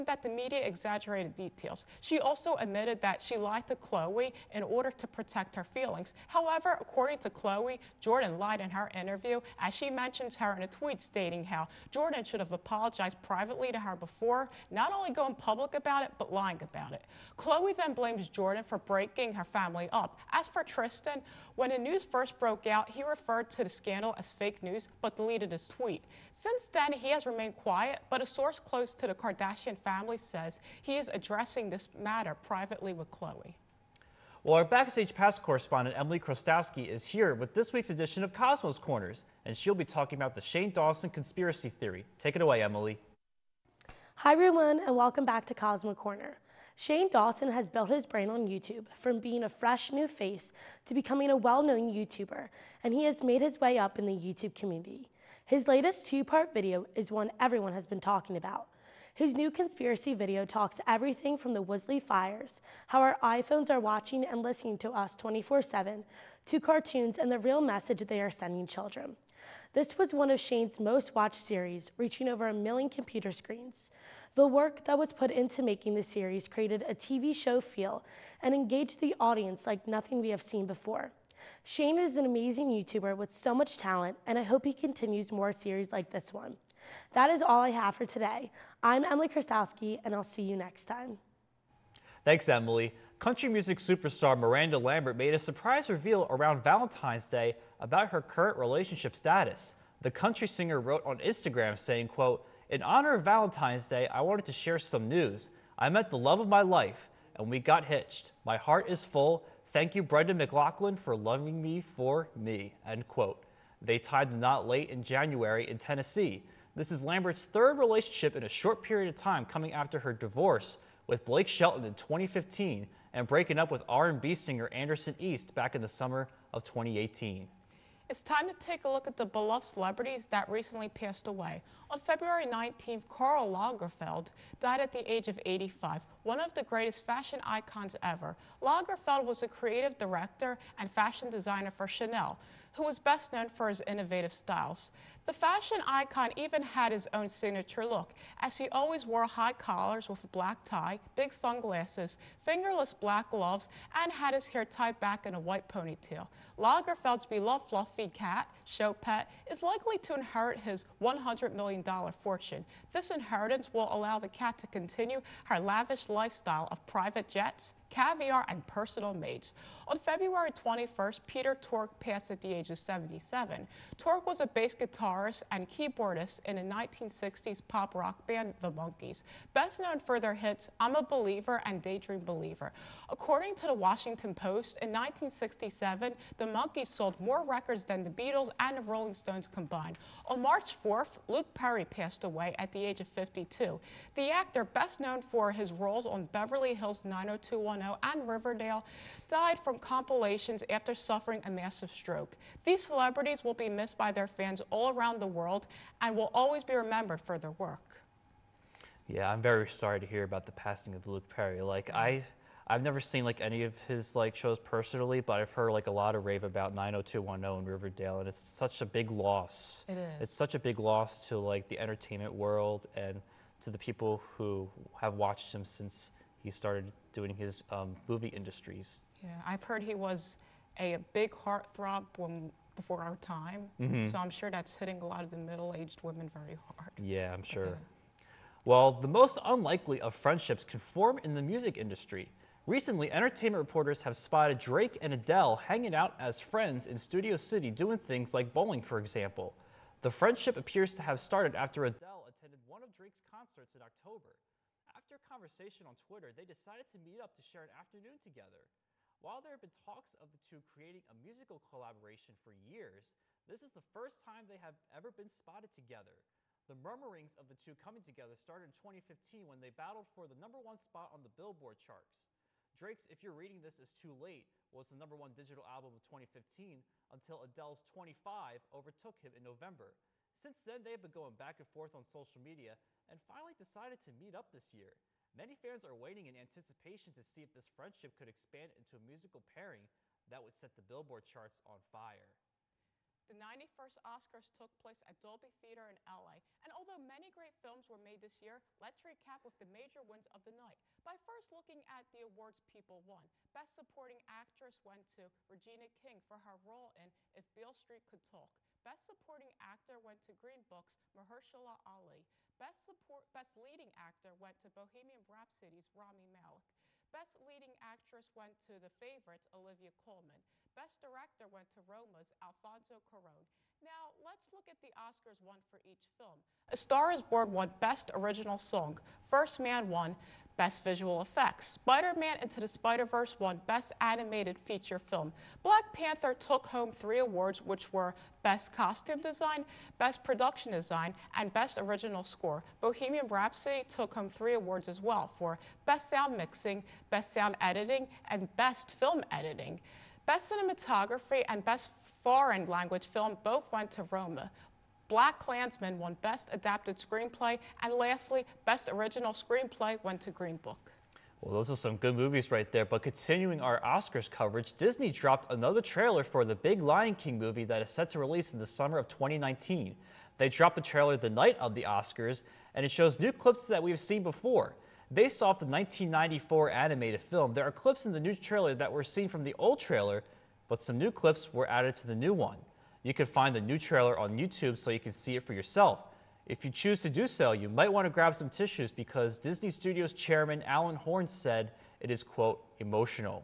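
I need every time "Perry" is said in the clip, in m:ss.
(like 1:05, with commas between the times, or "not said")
3:11, 3:31.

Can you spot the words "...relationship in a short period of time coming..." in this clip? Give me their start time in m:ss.
1:57.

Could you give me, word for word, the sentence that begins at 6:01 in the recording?
Well, those are some good movies right there.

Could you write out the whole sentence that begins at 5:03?
Best Supporting Actress went to Regina King for her role in If Beale Street Could Talk.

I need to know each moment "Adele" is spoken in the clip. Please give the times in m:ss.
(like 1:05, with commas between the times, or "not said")
4:05, 4:11, 4:37.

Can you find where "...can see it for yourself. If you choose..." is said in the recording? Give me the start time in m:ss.
6:24.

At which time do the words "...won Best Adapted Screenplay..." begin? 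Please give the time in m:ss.
5:55.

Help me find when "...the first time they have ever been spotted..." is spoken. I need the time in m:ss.
4:23.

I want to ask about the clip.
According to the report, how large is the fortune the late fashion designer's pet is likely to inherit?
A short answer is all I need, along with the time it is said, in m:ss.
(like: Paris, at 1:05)
$100 million, at 2:41.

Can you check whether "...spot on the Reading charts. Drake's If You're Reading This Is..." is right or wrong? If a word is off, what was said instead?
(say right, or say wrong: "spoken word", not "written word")
wrong: "Billboard", not "Reading".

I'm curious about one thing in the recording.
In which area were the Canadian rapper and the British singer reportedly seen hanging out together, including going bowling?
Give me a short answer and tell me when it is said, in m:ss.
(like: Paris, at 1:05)
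Studio City, at 4:06.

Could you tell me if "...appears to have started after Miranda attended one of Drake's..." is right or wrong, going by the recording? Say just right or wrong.
wrong.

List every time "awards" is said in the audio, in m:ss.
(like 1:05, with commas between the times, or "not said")
5:02, 5:37, 5:44.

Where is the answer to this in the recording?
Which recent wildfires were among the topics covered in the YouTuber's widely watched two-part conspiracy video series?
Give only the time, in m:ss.
1:01.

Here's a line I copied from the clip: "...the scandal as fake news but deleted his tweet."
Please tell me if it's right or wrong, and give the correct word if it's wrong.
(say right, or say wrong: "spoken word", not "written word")
right.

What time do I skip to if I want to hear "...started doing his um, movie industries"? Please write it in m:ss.
3:46.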